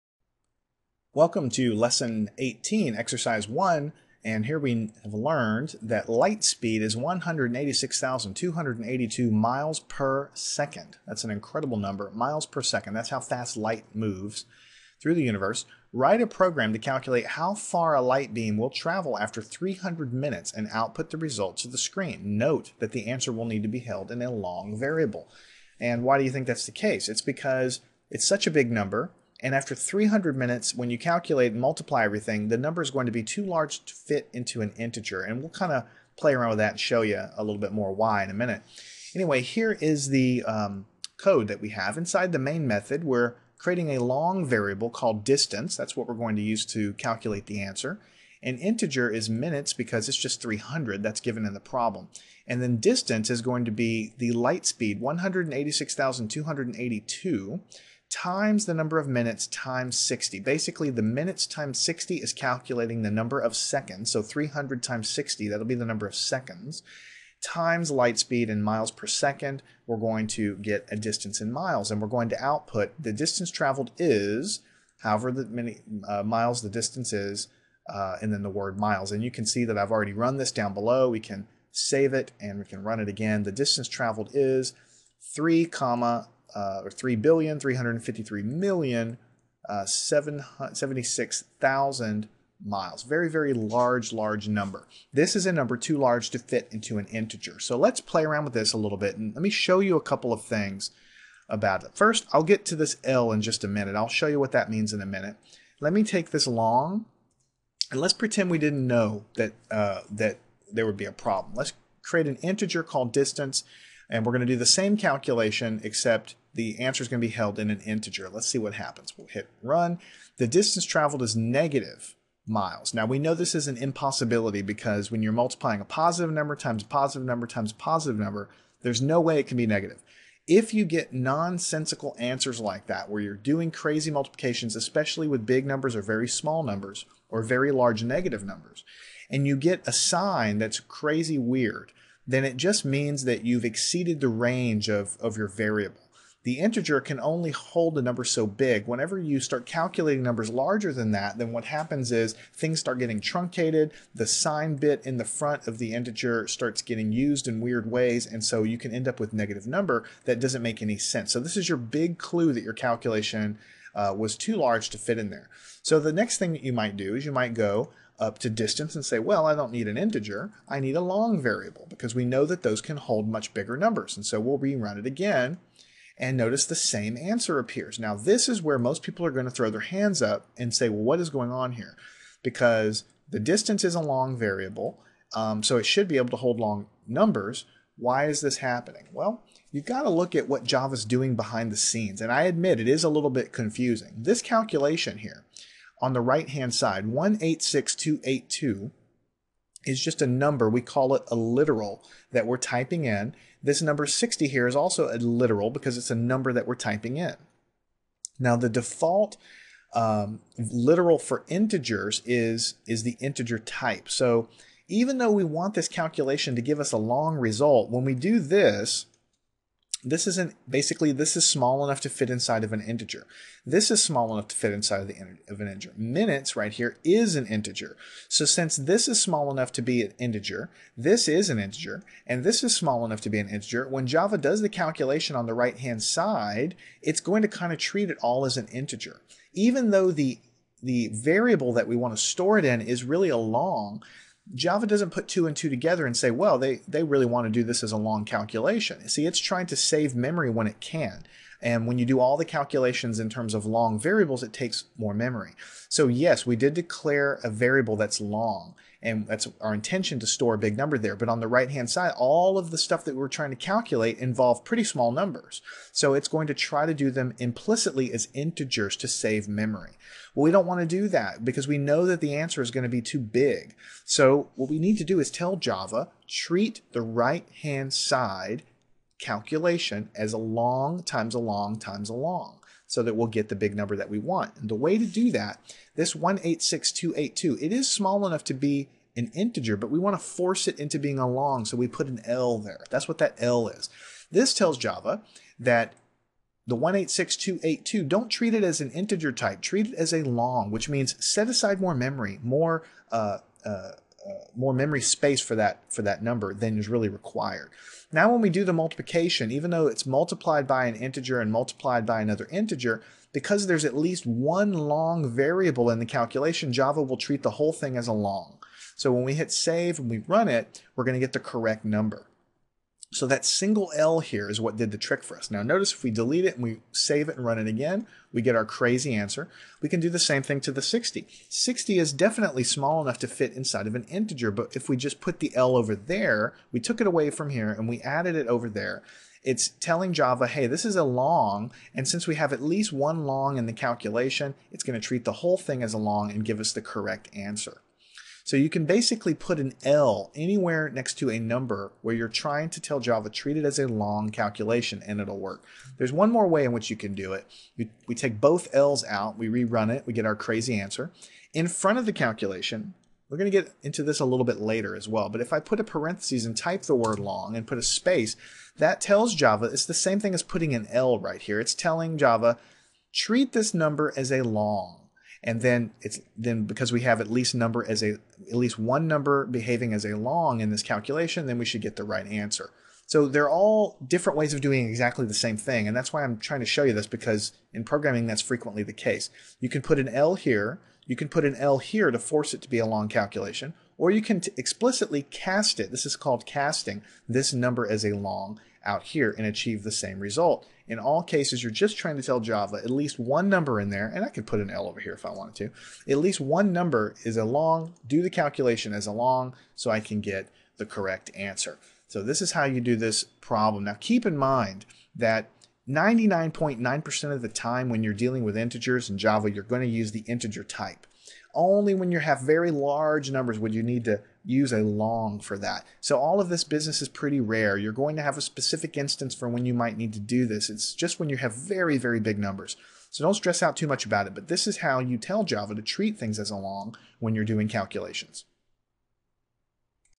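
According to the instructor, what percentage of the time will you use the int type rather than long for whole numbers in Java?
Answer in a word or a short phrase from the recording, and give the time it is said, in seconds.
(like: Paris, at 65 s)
99.9%, at 415 s.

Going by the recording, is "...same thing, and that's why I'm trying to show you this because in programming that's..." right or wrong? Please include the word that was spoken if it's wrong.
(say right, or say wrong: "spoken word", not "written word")
right.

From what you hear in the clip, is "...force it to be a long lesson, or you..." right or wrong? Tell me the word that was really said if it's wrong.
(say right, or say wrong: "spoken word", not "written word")
wrong: "calculation", not "lesson".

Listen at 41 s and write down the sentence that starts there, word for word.
Inside the main method, we're creating a long variable called distance.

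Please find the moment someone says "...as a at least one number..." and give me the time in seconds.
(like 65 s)
377 s.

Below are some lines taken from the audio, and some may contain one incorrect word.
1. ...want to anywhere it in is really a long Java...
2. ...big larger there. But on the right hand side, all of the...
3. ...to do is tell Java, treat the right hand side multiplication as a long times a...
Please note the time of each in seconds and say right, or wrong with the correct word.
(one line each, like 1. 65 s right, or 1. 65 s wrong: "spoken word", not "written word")
1. 241 s wrong: "store", not "anywhere"
2. 260 s wrong: "number", not "larger"
3. 274 s wrong: "calculation", not "multiplication".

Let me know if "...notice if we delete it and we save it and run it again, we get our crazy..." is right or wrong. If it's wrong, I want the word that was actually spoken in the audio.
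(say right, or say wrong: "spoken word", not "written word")
right.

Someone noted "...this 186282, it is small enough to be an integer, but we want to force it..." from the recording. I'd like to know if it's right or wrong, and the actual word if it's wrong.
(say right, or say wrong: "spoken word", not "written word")
right.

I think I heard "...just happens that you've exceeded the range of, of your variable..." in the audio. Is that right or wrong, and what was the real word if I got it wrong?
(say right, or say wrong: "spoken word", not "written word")
wrong: "means", not "happens".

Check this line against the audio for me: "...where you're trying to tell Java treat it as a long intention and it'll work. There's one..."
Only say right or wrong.
wrong.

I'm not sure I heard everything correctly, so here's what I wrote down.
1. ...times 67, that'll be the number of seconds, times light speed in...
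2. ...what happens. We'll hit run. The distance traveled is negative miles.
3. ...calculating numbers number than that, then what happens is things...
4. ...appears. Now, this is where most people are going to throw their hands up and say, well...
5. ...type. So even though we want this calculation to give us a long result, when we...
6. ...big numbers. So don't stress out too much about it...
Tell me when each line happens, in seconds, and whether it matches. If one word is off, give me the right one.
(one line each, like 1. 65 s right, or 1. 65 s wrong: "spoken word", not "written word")
1. 64 s wrong: "60", not "67"
2. 118 s right
3. 149 s wrong: "larger", not "number"
4. 177 s right
5. 213 s right
6. 432 s right.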